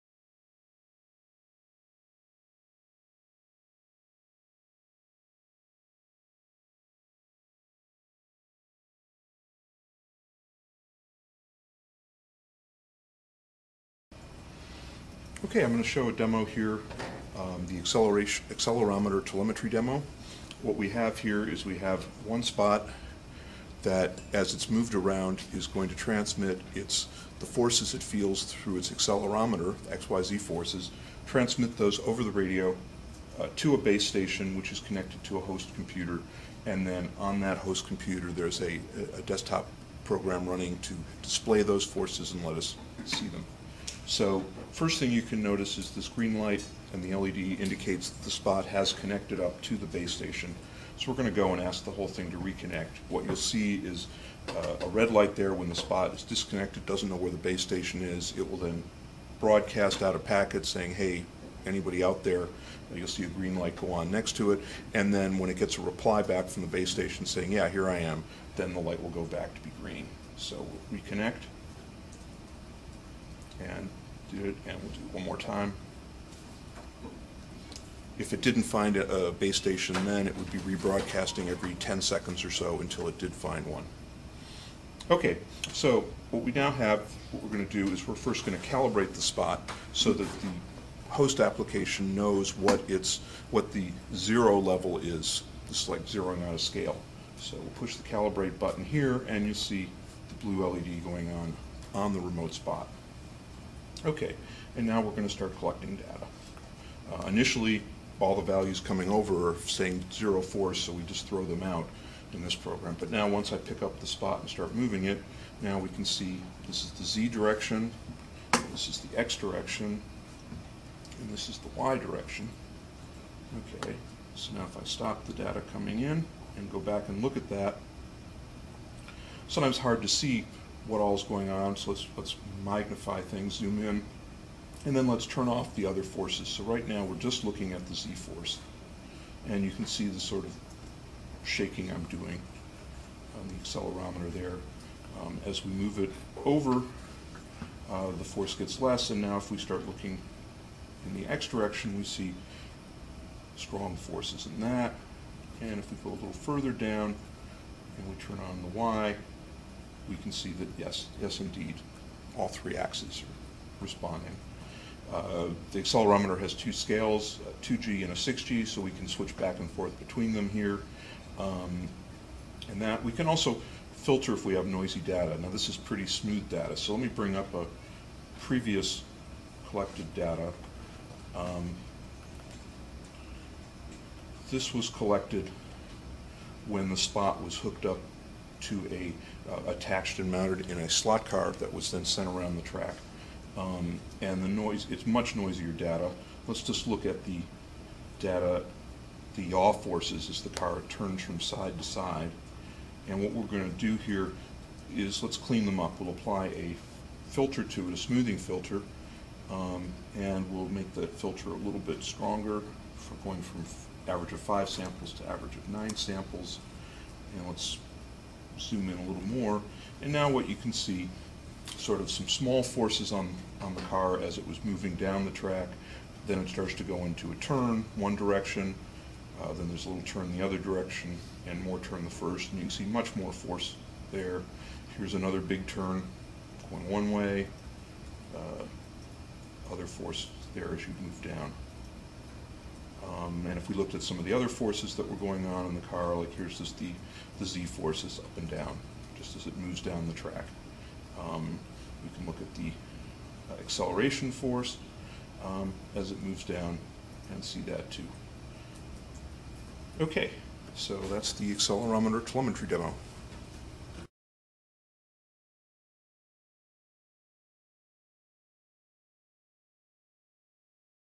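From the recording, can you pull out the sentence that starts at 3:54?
Here's another big turn going one way, uh, other force there as you move down.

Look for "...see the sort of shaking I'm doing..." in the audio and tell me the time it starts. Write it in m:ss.
2:19.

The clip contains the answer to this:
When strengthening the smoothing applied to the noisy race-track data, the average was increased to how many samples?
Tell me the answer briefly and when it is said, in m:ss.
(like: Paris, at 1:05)
9, at 3:35.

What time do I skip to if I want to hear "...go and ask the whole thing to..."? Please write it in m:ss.
0:51.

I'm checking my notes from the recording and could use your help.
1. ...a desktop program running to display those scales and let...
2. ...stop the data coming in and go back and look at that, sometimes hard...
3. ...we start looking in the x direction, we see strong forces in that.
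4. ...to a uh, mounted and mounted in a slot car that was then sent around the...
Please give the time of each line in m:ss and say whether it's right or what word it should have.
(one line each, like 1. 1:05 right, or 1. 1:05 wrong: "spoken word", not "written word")
1. 0:39 wrong: "forces", not "scales"
2. 2:04 right
3. 2:29 right
4. 3:08 wrong: "attached", not "mounted".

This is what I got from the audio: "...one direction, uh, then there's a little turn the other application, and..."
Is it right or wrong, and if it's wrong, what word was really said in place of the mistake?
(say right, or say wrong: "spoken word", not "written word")
wrong: "direction", not "application".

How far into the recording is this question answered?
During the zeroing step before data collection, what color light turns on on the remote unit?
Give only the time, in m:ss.
1:40.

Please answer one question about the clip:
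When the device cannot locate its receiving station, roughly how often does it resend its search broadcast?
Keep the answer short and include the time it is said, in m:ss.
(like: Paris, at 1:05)
every 10 seconds, at 1:21.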